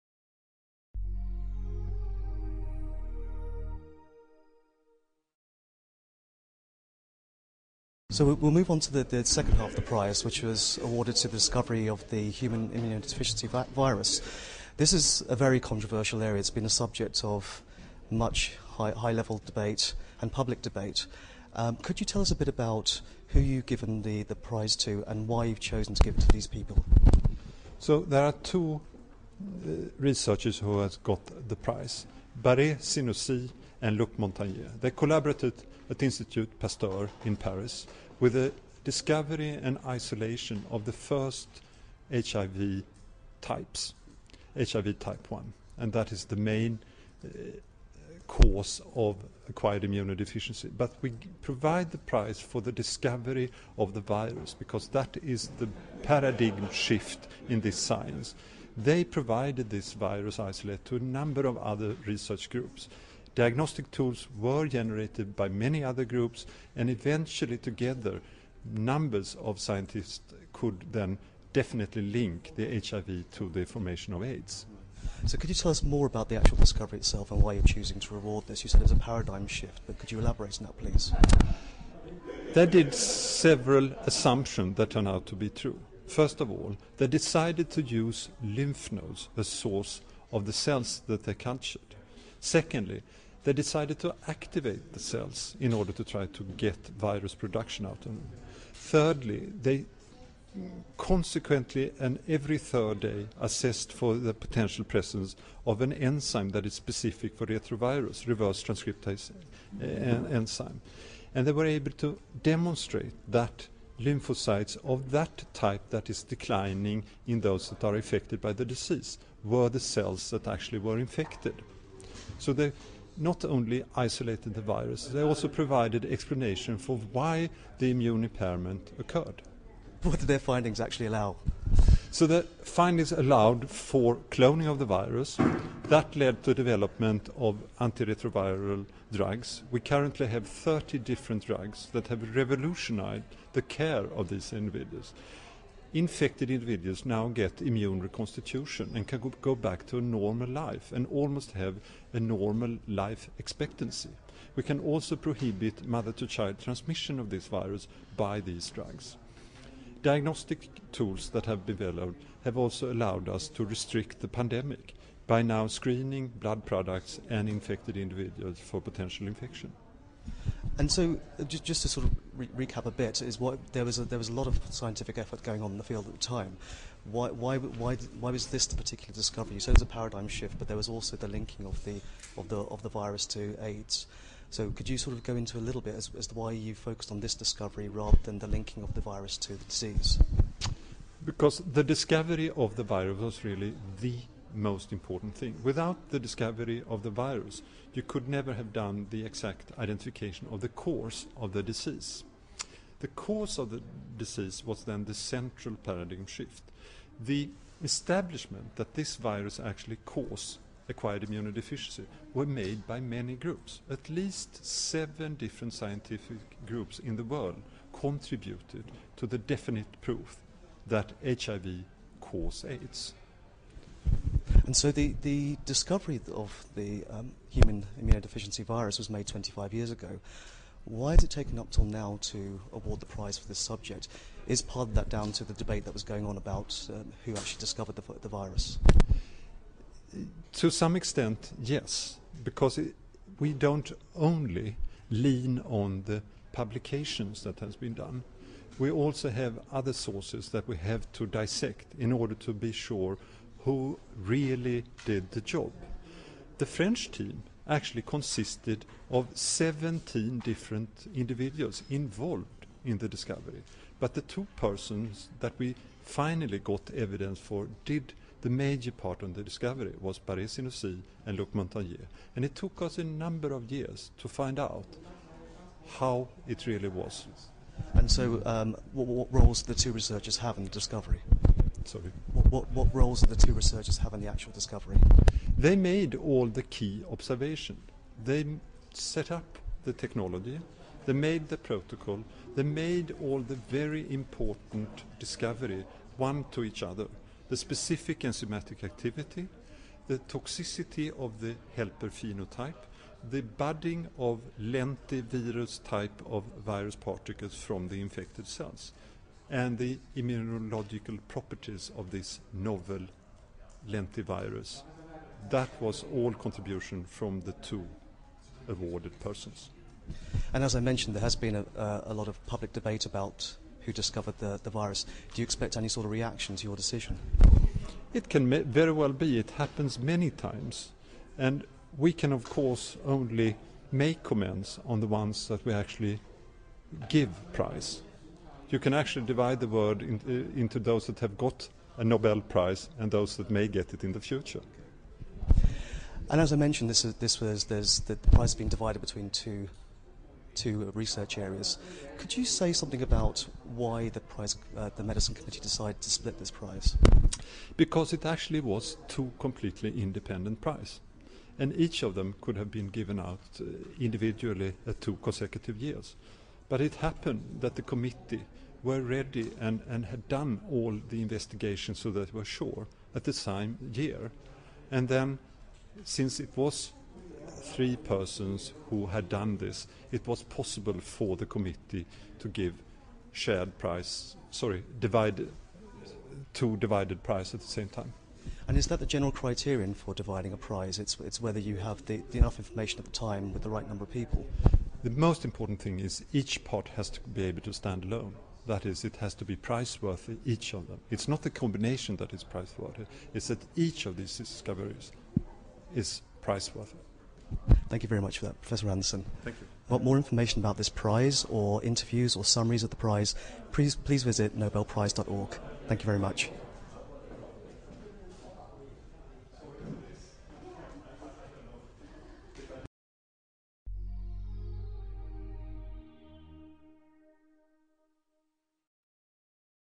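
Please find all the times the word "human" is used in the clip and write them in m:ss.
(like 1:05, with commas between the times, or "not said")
0:12, 3:47.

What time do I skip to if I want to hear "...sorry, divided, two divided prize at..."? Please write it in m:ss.
6:24.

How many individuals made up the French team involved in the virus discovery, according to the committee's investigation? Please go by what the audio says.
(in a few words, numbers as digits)
17.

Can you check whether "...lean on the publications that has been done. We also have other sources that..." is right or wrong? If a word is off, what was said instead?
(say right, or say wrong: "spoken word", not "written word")
right.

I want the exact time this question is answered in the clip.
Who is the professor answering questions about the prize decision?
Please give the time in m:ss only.
6:48.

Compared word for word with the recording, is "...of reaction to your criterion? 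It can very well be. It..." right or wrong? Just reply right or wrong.
wrong.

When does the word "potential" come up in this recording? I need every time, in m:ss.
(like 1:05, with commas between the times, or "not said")
1:44, 2:48.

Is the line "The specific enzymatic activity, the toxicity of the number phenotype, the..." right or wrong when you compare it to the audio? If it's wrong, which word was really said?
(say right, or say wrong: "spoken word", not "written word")
wrong: "helper", not "number".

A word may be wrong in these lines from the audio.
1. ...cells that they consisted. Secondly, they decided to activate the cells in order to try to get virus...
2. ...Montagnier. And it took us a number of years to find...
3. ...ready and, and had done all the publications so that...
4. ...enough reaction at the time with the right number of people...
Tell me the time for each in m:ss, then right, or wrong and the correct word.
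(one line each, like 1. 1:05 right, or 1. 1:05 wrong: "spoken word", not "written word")
1. 1:30 wrong: "cultured", not "consisted"
2. 4:31 right
3. 6:09 wrong: "investigations", not "publications"
4. 6:32 wrong: "information", not "reaction".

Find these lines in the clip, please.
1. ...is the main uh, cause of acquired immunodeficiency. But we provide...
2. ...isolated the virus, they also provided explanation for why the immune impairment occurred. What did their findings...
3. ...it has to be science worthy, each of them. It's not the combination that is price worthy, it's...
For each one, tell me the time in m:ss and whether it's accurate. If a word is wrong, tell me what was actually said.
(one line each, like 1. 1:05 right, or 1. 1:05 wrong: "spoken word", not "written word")
1. 0:46 right
2. 2:03 right
3. 6:39 wrong: "price", not "science".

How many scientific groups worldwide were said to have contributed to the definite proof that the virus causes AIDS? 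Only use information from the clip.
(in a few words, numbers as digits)
7.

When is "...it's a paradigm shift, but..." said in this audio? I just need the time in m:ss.
1:18.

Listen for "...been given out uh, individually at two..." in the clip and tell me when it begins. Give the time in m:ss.
6:02.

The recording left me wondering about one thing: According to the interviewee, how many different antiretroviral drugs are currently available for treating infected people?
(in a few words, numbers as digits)
30.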